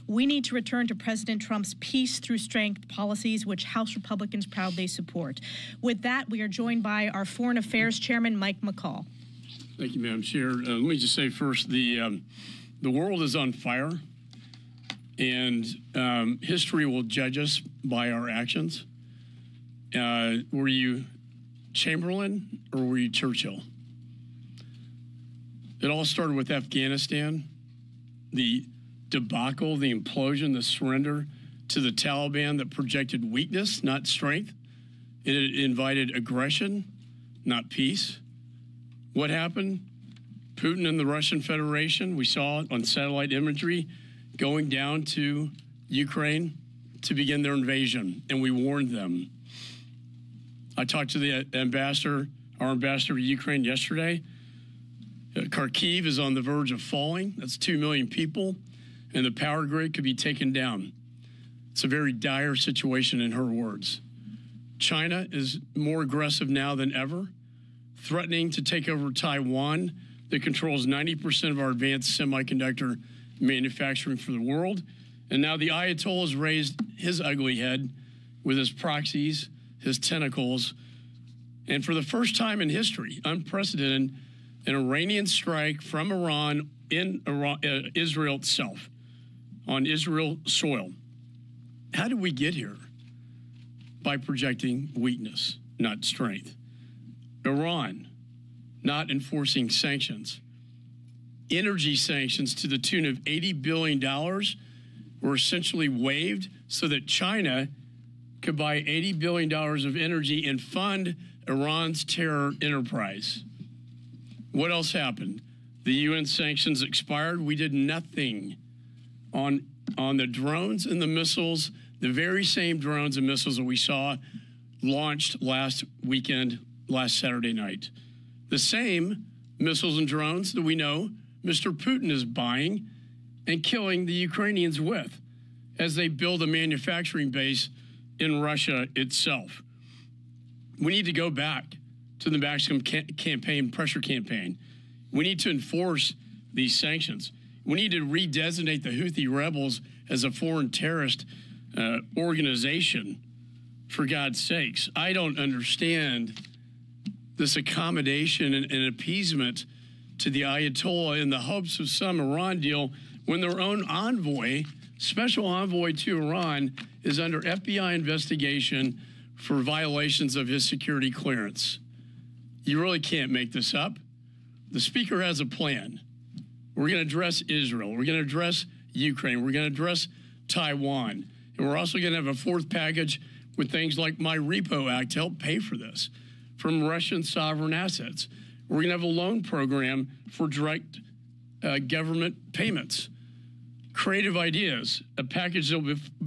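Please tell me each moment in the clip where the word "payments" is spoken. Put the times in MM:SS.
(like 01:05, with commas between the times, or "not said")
03:12.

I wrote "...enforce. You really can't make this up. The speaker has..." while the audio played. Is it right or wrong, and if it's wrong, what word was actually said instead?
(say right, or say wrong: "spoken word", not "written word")
wrong: "clearance", not "enforce".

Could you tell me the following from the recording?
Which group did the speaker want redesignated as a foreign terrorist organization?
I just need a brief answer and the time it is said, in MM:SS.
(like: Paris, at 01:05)
Houthi rebels, at 02:28.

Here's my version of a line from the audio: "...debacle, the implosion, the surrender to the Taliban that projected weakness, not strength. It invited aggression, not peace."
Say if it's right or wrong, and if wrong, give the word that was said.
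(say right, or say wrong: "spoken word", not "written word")
right.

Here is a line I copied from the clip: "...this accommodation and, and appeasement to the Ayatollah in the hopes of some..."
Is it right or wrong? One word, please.
right.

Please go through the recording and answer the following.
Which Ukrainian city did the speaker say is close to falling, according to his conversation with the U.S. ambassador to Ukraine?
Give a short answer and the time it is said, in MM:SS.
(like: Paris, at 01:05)
Kharkiv, at 00:55.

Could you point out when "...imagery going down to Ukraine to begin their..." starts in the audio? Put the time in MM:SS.
00:43.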